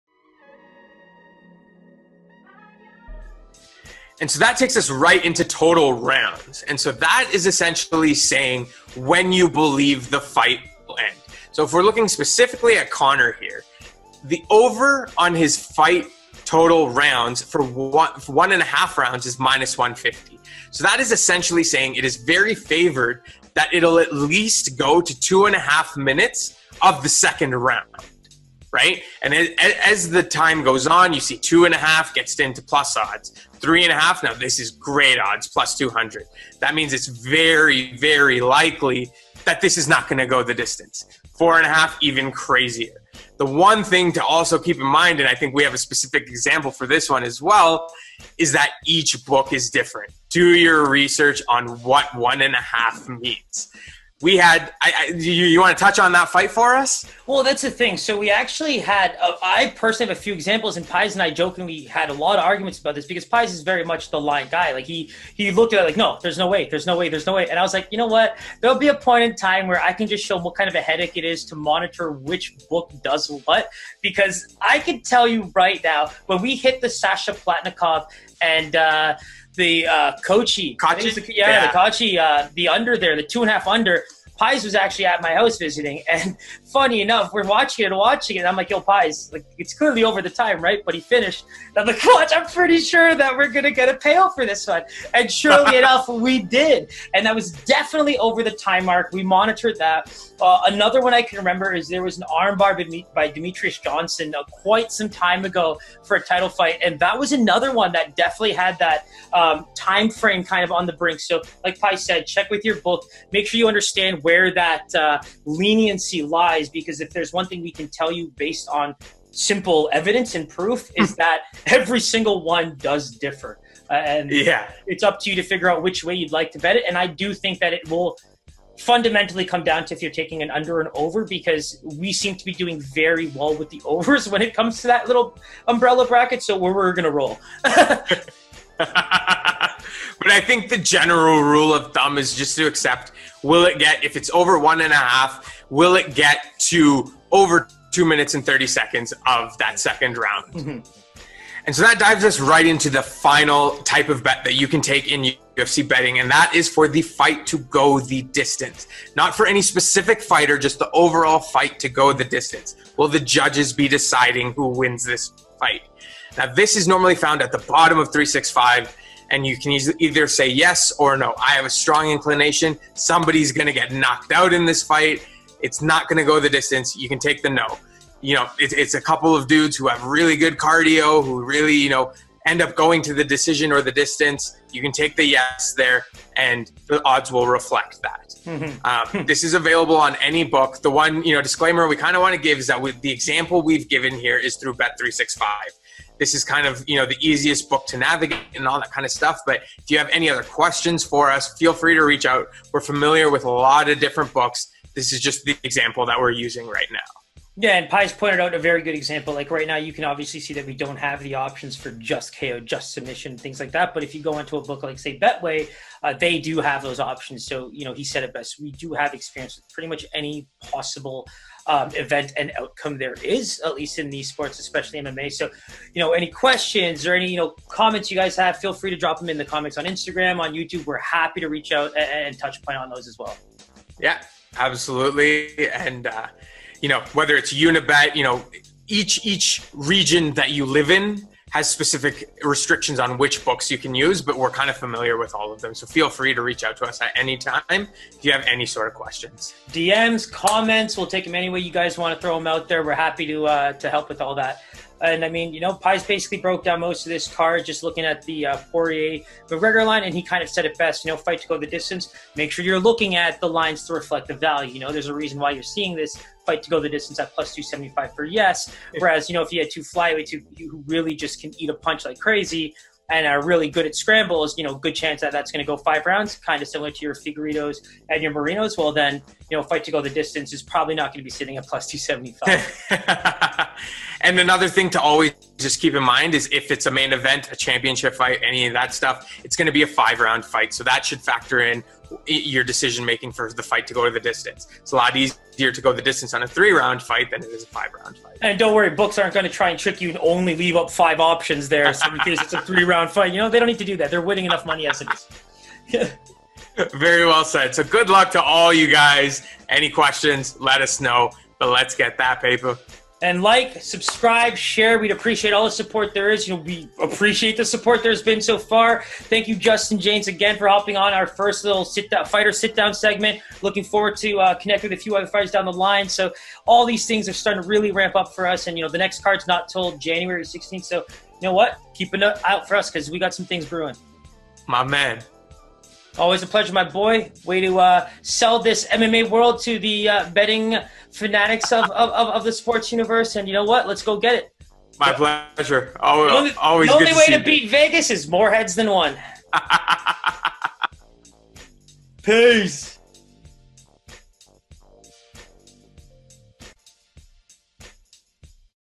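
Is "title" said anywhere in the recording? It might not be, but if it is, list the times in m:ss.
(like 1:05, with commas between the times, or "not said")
1:46.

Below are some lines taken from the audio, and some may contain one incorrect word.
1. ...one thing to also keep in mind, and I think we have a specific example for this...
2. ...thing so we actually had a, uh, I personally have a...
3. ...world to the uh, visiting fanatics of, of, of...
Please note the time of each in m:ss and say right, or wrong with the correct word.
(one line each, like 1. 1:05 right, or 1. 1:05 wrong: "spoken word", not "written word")
1. 0:43 right
2. 0:57 right
3. 5:39 wrong: "betting", not "visiting".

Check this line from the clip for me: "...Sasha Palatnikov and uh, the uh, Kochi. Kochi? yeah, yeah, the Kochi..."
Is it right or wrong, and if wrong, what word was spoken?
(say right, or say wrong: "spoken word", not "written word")
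right.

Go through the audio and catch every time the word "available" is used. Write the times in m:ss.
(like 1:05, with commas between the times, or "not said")
3:09.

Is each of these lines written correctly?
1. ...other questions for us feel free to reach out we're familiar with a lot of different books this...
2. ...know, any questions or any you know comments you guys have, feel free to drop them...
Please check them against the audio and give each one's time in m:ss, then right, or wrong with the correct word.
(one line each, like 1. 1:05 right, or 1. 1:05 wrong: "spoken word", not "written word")
1. 3:20 right
2. 3:45 right.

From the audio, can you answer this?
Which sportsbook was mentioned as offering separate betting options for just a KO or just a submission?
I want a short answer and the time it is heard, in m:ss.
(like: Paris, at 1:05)
Betway, at 3:35.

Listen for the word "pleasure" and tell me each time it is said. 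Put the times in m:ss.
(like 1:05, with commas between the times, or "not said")
5:36, 5:45.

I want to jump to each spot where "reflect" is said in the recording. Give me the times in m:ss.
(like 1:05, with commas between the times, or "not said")
3:07, 4:23.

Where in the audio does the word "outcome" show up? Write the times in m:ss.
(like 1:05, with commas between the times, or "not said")
3:42.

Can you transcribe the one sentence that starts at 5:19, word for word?
Thank you, Justin James, again for hopping on our first little sit down, fighter sit down segment.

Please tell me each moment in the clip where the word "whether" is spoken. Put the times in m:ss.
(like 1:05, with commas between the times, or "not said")
3:57.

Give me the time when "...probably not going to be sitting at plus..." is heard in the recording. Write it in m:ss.
4:40.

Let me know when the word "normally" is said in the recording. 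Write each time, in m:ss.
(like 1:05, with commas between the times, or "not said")
2:46.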